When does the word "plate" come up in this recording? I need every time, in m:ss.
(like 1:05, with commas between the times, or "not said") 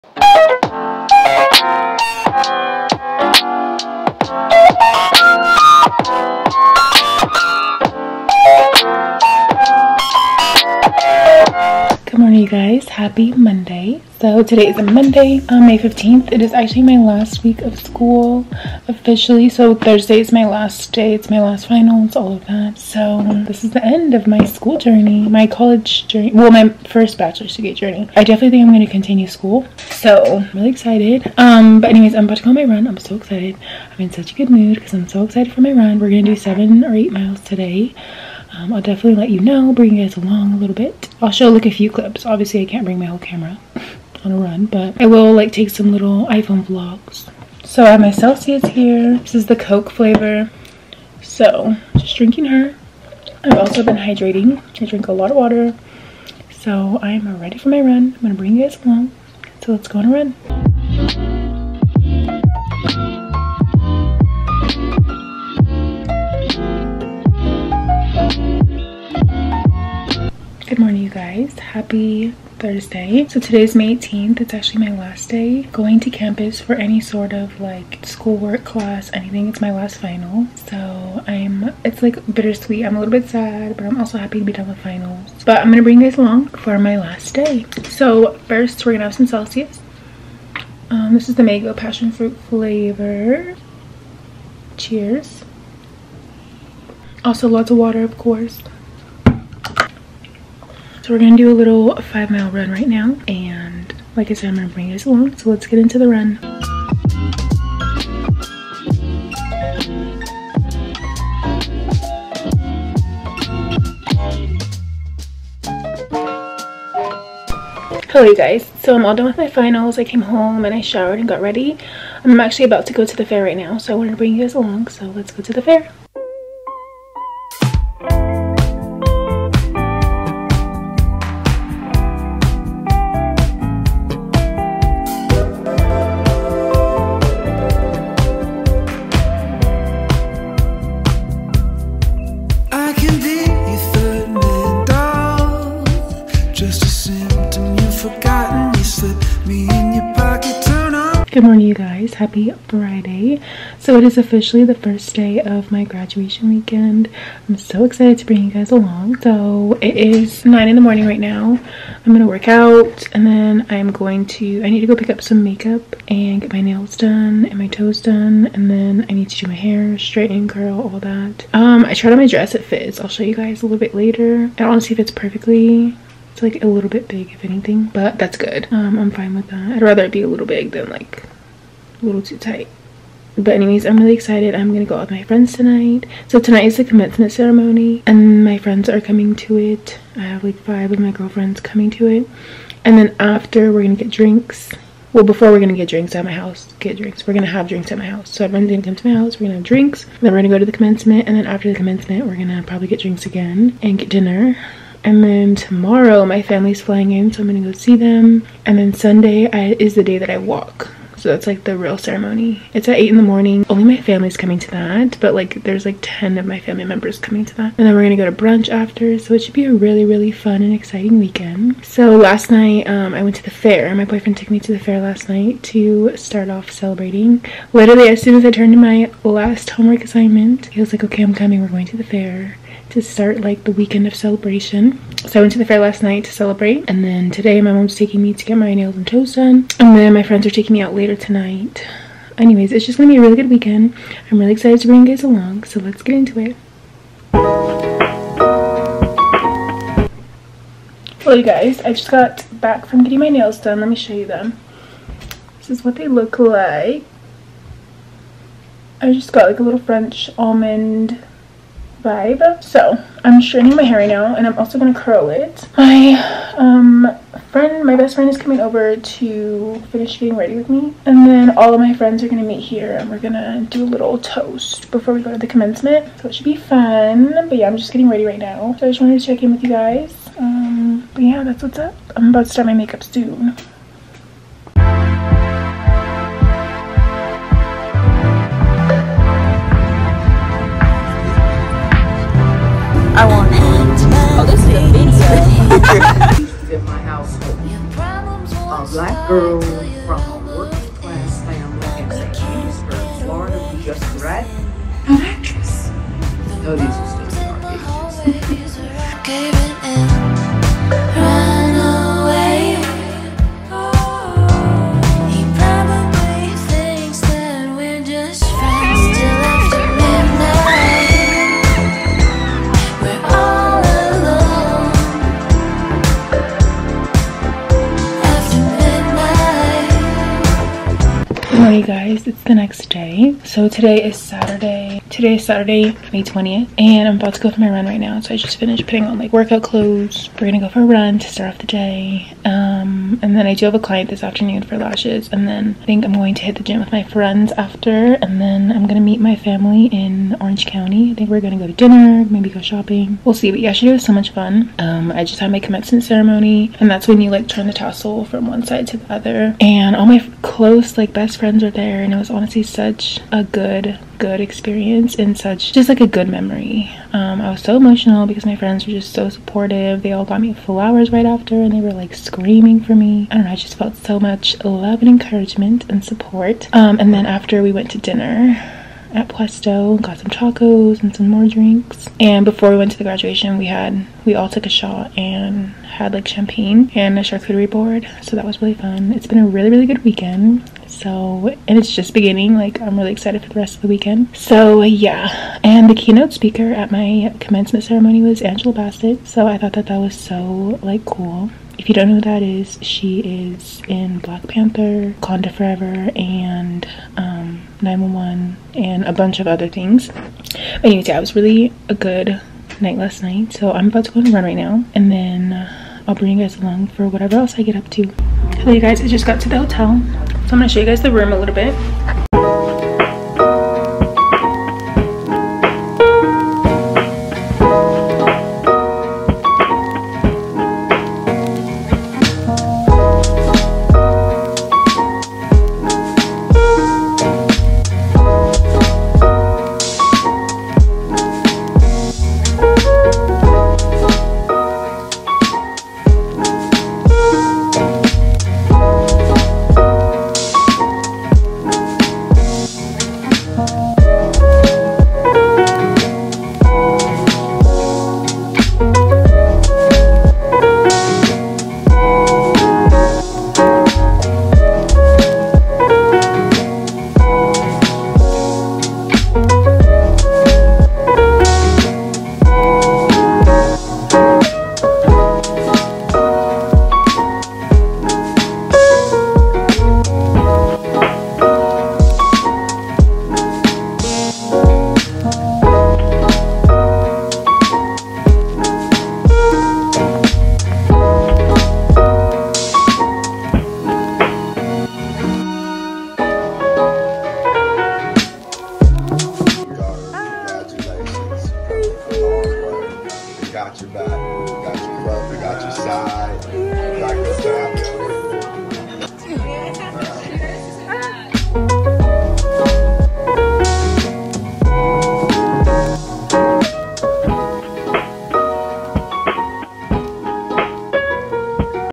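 not said.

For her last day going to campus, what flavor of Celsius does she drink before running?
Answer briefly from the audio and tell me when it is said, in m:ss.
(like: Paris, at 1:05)
Mango passion fruit, at 1:31.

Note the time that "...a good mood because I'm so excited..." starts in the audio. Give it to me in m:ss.
0:34.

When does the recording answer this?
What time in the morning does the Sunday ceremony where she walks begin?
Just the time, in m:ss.
3:32.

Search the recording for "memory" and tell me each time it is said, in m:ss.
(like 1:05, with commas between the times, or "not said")
6:06.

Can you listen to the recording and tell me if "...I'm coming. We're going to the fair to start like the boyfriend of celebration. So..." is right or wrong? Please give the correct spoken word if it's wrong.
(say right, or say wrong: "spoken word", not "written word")
wrong: "weekend", not "boyfriend".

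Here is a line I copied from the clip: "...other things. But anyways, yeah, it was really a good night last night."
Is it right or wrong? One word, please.
right.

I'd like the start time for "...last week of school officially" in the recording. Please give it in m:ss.
0:16.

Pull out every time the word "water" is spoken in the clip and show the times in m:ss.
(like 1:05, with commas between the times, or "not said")
0:55, 1:37.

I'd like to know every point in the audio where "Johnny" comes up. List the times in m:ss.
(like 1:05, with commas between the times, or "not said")
not said.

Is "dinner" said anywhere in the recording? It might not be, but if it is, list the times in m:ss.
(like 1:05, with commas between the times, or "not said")
3:24, 5:51, 6:17.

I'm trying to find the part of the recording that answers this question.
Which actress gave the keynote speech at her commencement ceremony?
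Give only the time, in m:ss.
6:38.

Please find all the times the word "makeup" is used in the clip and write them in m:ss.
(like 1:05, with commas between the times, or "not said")
2:45, 4:42.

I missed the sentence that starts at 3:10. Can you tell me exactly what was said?
I have like five of my girlfriends coming to it, and then after we're gonna get drinks.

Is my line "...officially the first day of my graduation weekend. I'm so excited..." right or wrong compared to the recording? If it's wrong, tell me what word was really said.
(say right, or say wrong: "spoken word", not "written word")
right.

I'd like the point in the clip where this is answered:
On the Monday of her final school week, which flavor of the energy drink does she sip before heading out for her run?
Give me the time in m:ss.
0:49.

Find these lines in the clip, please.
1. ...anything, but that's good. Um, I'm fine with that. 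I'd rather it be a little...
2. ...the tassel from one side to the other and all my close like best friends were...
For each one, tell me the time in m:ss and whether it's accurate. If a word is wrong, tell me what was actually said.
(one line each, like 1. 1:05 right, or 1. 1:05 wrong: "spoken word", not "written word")
1. 2:57 right
2. 5:57 right.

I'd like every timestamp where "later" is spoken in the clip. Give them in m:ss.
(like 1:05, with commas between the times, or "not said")
2:53, 4:00.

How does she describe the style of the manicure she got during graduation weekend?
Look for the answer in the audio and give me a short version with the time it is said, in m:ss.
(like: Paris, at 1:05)
French almond, at 4:19.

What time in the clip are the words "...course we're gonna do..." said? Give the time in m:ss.
1:38.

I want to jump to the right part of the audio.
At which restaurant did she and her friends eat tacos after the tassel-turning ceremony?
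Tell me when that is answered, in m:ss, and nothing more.
6:19.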